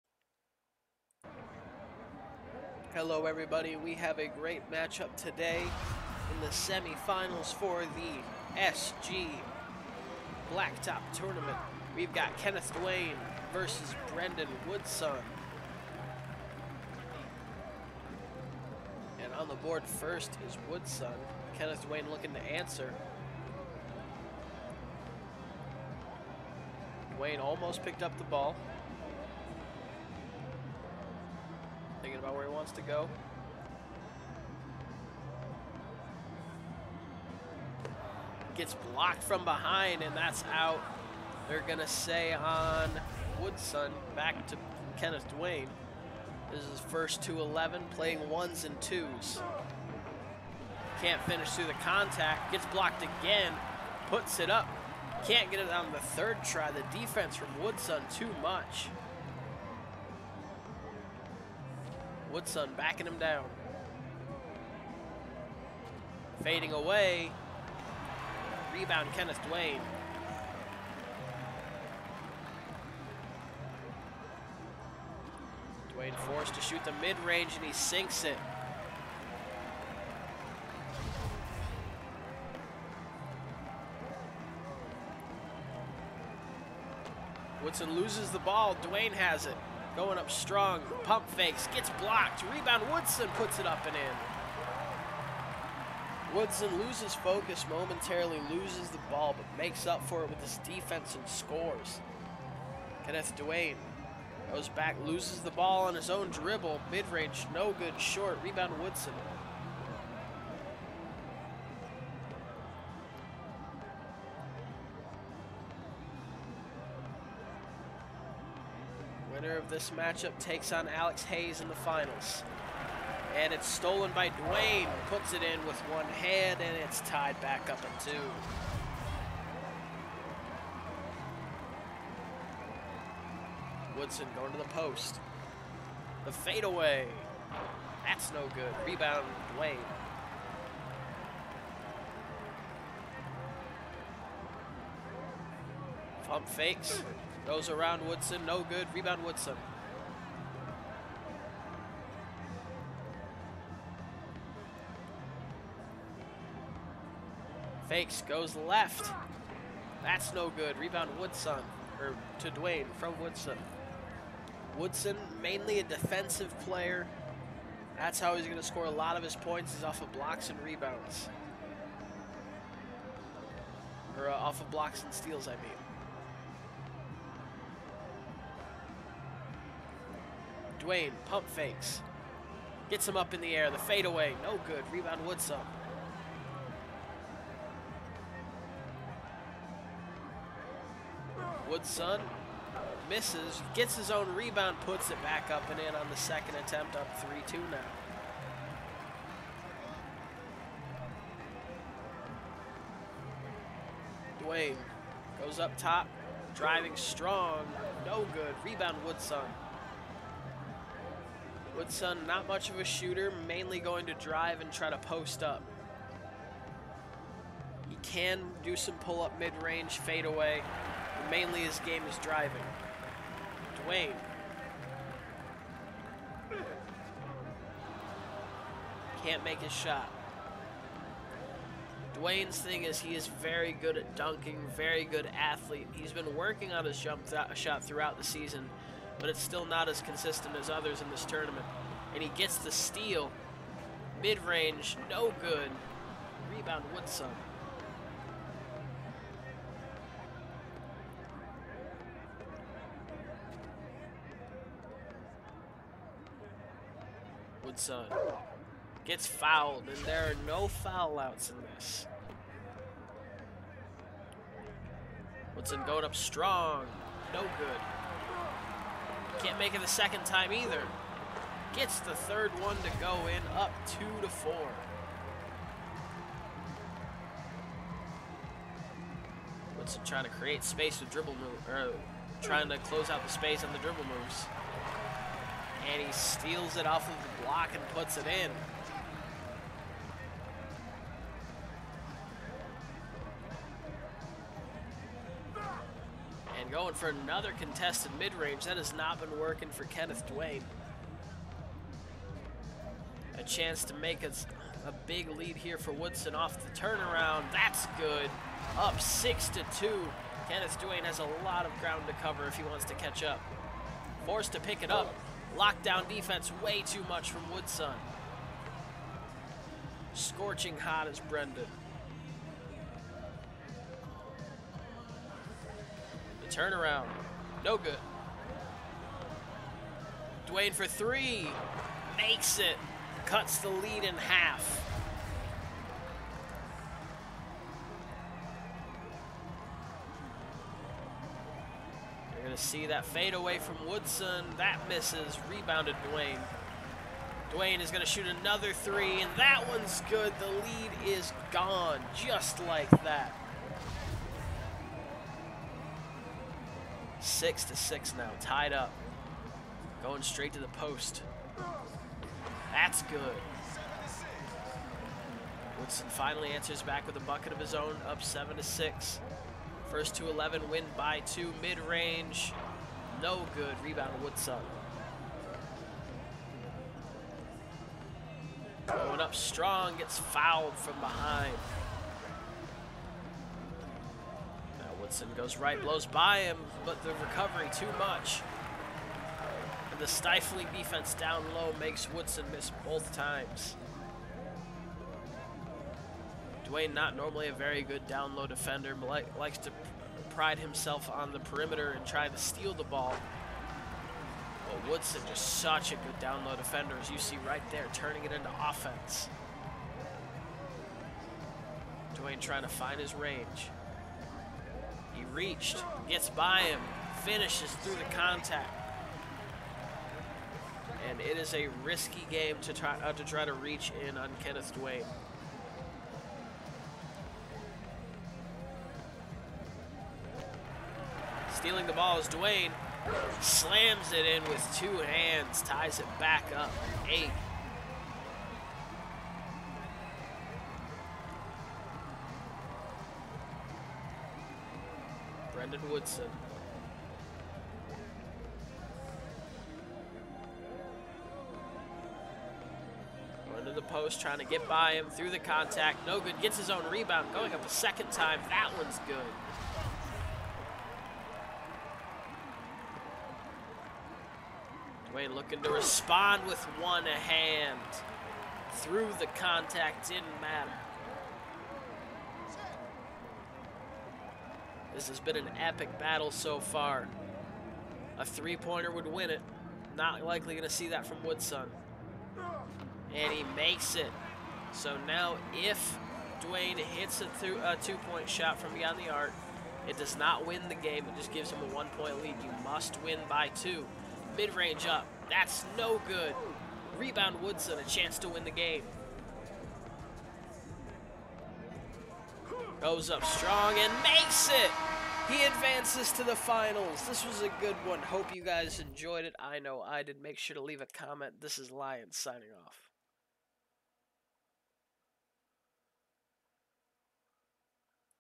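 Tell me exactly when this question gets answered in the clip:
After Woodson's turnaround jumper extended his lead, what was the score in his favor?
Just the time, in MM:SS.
05:09.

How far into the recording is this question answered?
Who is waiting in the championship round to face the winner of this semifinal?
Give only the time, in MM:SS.
02:00.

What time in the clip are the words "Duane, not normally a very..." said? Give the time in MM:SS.
06:36.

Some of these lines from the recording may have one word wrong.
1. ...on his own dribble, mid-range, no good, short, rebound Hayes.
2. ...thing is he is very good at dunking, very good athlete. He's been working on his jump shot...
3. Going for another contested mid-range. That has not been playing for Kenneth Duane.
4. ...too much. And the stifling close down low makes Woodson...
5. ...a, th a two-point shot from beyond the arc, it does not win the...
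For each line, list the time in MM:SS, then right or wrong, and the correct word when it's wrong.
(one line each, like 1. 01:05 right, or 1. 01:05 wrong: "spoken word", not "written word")
1. 01:45 wrong: "Woodson", not "Hayes"
2. 03:52 right
3. 04:56 wrong: "working", not "playing"
4. 06:27 wrong: "defense", not "close"
5. 08:07 right.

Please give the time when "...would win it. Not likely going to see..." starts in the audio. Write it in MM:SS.
07:58.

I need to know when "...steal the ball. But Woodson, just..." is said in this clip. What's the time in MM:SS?
06:42.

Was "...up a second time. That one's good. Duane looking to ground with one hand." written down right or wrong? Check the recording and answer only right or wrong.
wrong.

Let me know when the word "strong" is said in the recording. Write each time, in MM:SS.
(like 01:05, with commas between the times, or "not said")
01:30, 03:26, 04:26, 06:19, 08:23.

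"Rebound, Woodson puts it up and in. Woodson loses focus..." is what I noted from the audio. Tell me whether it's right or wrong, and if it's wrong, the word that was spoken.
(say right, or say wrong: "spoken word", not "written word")
right.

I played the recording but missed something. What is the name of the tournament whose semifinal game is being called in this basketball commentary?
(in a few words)
SG Blacktop Tournament.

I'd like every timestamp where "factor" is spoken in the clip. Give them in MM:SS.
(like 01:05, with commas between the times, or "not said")
not said.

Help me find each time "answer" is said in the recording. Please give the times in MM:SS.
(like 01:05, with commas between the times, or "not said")
00:22, 06:06.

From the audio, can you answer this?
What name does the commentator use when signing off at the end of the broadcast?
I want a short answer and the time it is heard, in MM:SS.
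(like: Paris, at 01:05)
Lion, at 08:31.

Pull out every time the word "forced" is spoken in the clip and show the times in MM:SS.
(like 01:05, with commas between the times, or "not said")
01:16, 05:14.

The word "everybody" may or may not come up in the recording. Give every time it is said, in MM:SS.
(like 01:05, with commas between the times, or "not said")
00:03.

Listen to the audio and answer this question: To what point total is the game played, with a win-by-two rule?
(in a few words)
11.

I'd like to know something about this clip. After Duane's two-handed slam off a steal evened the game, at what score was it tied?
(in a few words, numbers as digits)
8.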